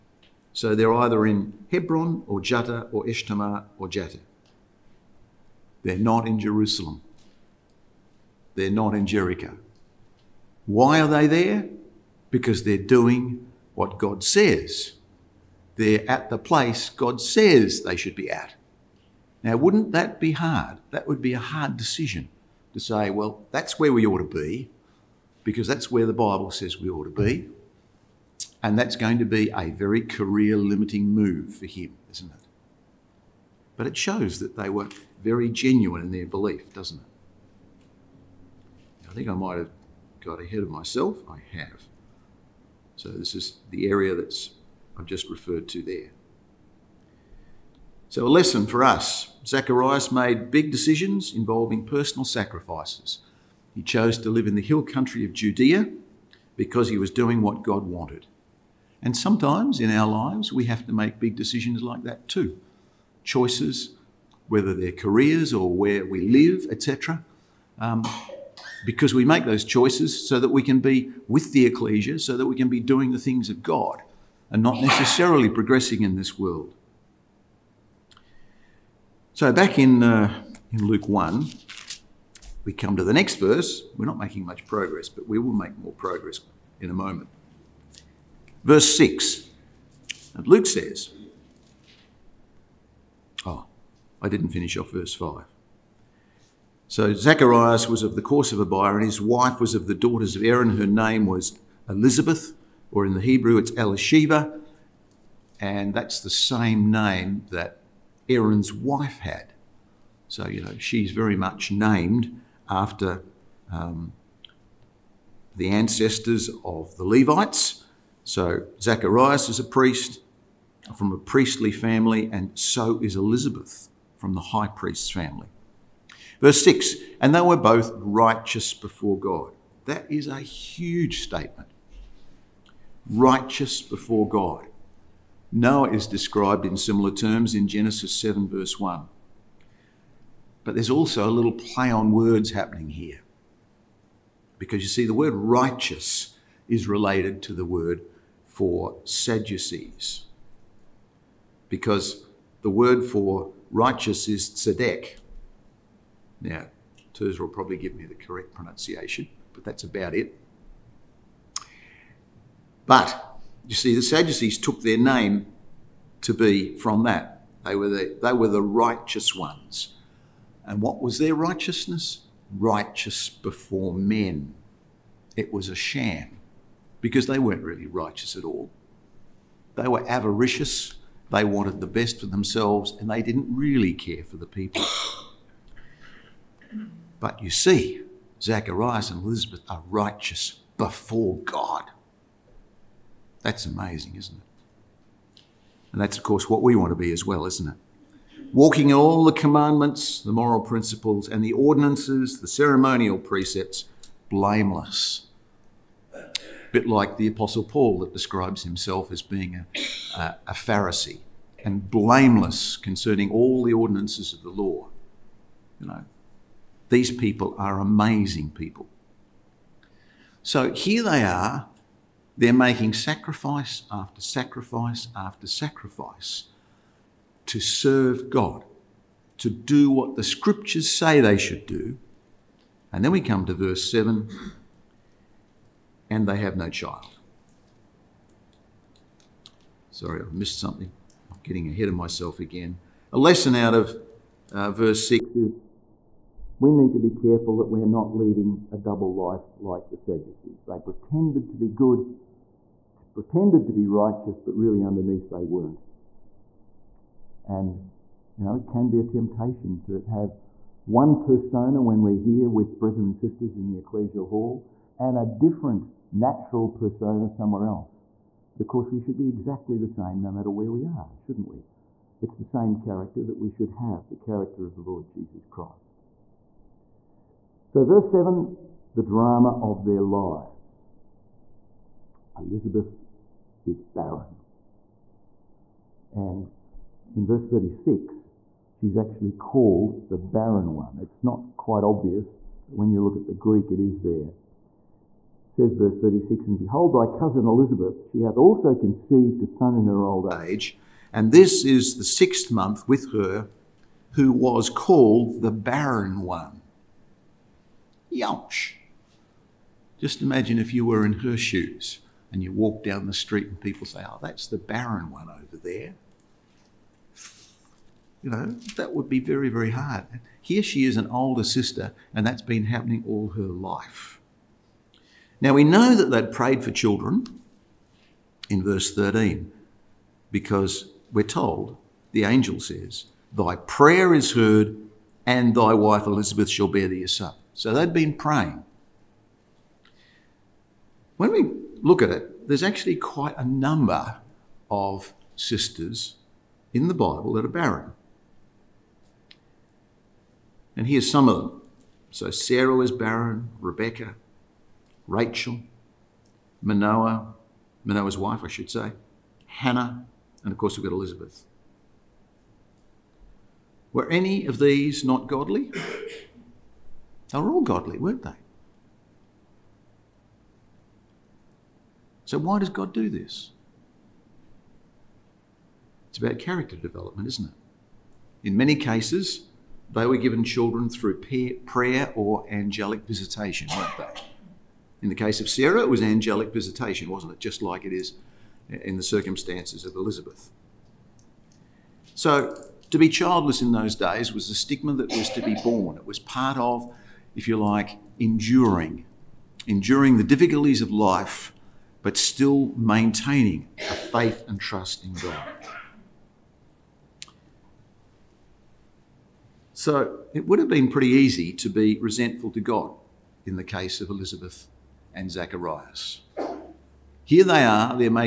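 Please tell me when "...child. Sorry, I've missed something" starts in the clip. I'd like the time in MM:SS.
03:56.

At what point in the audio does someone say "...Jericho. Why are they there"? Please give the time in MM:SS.
00:09.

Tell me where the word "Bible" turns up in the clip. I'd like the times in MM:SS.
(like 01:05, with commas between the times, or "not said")
00:26, 05:46.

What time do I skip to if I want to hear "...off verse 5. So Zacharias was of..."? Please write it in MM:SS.
01:34.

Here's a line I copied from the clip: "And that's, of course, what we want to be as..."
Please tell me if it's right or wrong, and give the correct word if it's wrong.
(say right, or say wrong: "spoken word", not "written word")
right.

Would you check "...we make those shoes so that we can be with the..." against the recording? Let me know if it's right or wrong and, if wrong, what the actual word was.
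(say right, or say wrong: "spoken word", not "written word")
wrong: "choices", not "shoes".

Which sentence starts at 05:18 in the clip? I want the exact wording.
You know, that would be very, very hard.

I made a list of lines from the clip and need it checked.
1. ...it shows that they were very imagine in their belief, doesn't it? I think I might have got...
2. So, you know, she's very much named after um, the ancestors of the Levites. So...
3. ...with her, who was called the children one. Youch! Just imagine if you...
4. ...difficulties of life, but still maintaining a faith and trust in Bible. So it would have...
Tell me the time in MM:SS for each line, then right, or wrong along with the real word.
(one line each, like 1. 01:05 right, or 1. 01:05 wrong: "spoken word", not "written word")
1. 00:33 wrong: "genuine", not "imagine"
2. 01:50 right
3. 05:02 wrong: "barren", not "children"
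4. 06:40 wrong: "God", not "Bible".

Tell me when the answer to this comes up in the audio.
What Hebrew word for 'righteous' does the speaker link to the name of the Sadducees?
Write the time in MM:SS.
02:34.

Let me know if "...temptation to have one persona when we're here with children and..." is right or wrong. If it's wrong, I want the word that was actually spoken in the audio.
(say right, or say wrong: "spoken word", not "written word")
wrong: "brethren", not "children".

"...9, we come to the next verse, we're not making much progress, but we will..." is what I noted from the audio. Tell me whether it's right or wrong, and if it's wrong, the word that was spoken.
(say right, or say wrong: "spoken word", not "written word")
wrong: "1", not "9".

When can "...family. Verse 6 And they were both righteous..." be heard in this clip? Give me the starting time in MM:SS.
02:05.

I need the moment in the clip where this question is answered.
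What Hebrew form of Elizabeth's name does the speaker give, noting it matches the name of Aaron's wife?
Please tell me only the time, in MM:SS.
01:43.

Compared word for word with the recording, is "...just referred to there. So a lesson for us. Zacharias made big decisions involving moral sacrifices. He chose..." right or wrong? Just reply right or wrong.
wrong.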